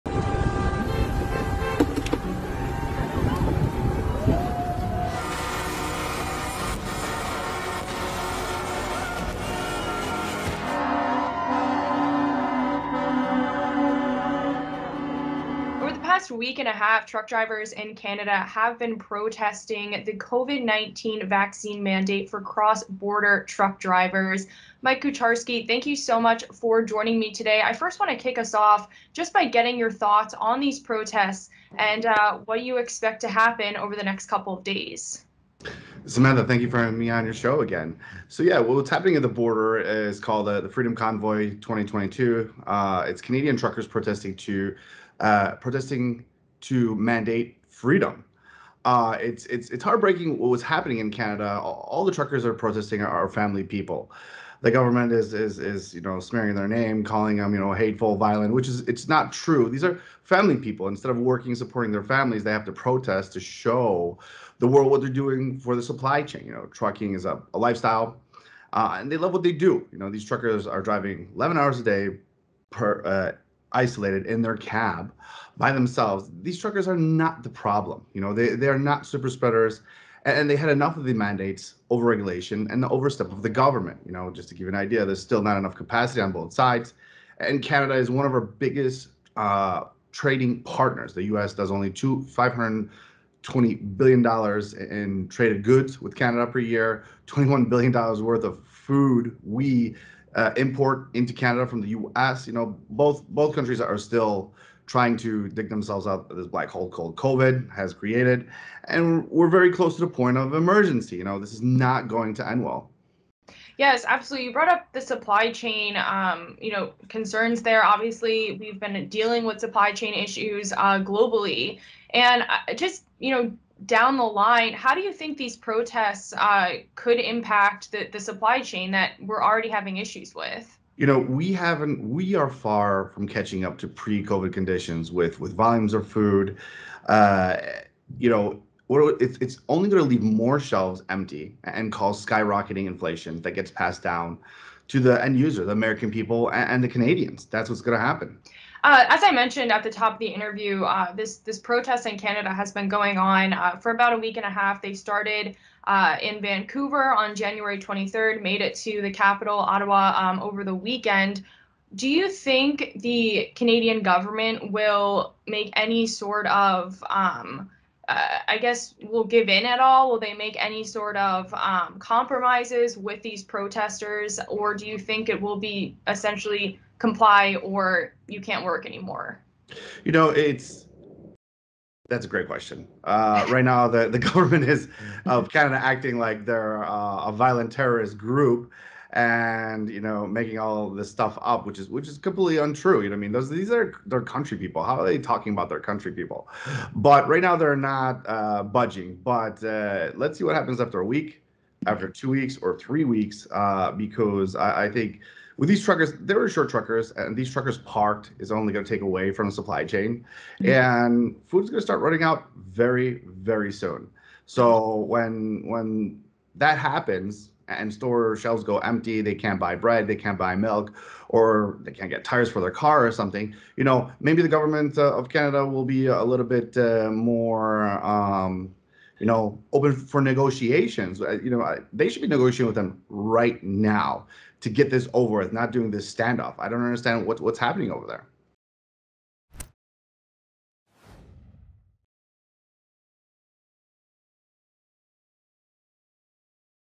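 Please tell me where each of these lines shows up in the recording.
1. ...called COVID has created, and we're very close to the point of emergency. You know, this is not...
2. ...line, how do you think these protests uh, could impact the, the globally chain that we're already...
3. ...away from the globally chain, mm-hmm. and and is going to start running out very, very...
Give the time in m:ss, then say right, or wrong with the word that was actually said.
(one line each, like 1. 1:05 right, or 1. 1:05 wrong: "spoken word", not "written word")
1. 1:46 right
2. 2:04 wrong: "supply", not "globally"
3. 3:29 wrong: "supply", not "globally".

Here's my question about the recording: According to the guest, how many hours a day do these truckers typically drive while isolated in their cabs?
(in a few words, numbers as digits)
11.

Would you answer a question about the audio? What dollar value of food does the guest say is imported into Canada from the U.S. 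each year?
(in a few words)
$21 billion.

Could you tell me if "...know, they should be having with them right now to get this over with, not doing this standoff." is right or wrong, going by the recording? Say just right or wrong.
wrong.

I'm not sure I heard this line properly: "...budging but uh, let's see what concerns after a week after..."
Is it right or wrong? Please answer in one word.
wrong.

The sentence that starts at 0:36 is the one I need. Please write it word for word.
Samantha, thank you for having me on your show again.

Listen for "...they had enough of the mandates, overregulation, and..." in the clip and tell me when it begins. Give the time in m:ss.
1:20.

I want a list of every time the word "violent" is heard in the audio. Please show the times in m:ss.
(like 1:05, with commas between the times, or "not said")
0:58, 3:07.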